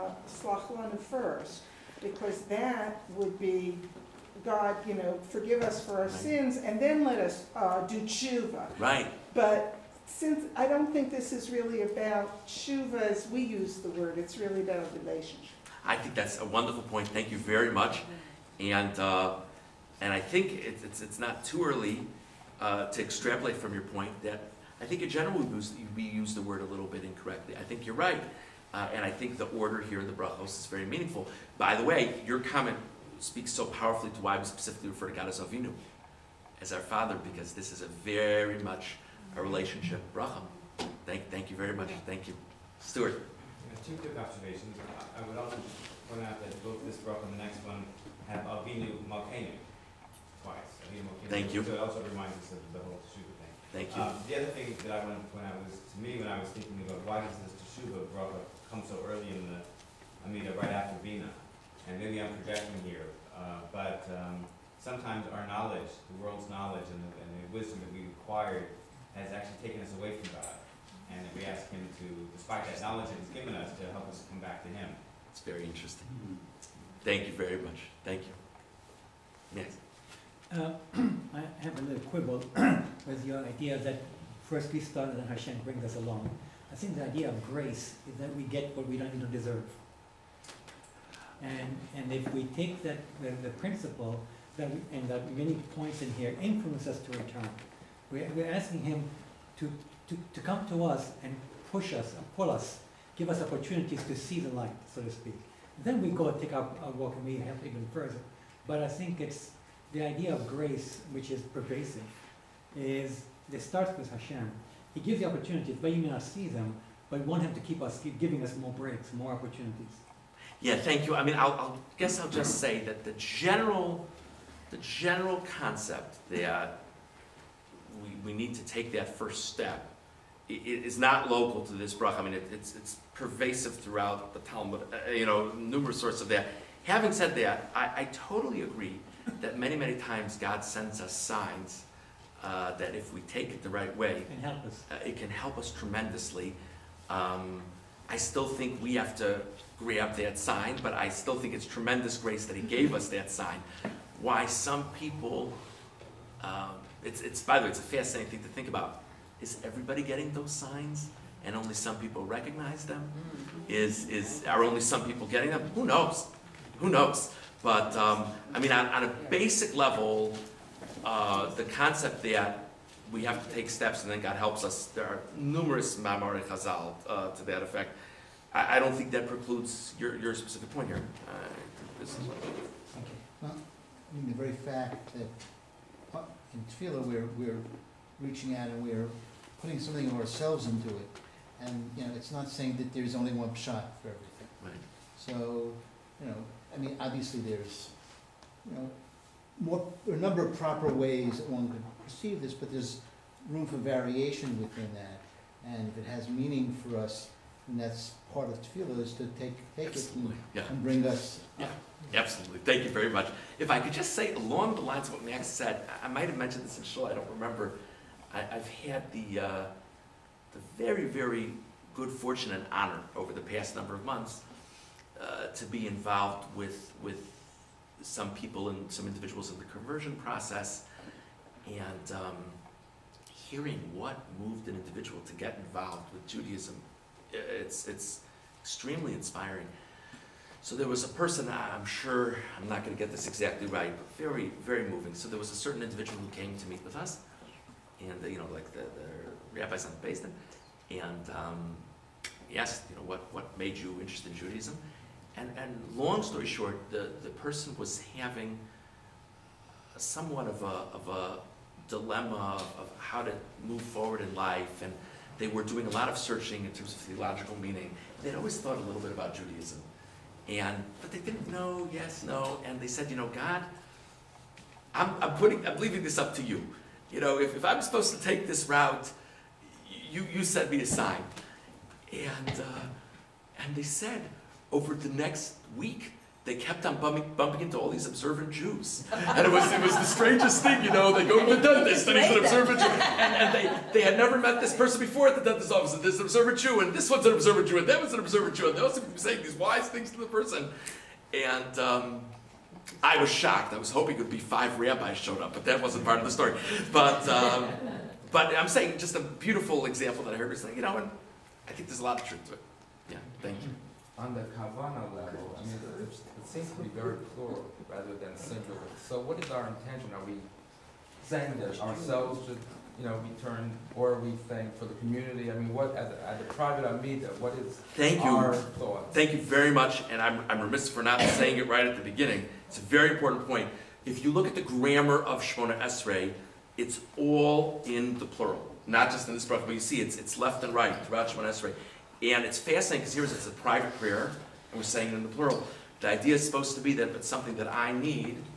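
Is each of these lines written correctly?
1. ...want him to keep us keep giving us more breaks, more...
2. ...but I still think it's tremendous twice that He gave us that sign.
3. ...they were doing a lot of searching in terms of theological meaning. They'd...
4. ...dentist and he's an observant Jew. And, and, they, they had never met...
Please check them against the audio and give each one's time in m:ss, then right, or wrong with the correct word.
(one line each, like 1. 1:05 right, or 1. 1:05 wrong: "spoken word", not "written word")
1. 1:57 right
2. 2:30 wrong: "grace", not "twice"
3. 4:25 right
4. 4:51 right.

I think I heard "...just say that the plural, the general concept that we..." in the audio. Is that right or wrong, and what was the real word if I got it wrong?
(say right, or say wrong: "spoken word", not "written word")
wrong: "general", not "plural".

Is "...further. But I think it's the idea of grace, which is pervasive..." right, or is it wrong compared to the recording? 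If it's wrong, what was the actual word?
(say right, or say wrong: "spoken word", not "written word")
right.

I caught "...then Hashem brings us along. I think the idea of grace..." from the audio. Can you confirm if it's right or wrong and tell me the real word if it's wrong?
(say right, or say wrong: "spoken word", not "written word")
right.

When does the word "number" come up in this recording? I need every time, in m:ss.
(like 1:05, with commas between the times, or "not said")
3:20, 3:43.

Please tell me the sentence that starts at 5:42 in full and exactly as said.
And it's fascinating because here's it's a private prayer, and we're saying it in the plural.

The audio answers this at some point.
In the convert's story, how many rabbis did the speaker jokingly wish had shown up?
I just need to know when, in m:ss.
5:04.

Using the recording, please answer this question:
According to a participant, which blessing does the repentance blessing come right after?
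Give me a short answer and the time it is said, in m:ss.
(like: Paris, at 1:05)
Bina, at 1:01.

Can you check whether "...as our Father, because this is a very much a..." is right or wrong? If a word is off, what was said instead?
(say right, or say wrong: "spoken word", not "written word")
right.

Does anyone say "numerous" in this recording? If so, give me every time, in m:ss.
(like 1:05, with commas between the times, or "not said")
2:15, 2:55.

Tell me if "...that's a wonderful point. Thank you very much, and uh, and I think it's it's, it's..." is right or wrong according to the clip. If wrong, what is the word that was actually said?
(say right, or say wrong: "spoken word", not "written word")
right.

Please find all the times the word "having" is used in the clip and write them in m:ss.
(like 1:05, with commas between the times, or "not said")
2:16, 4:18.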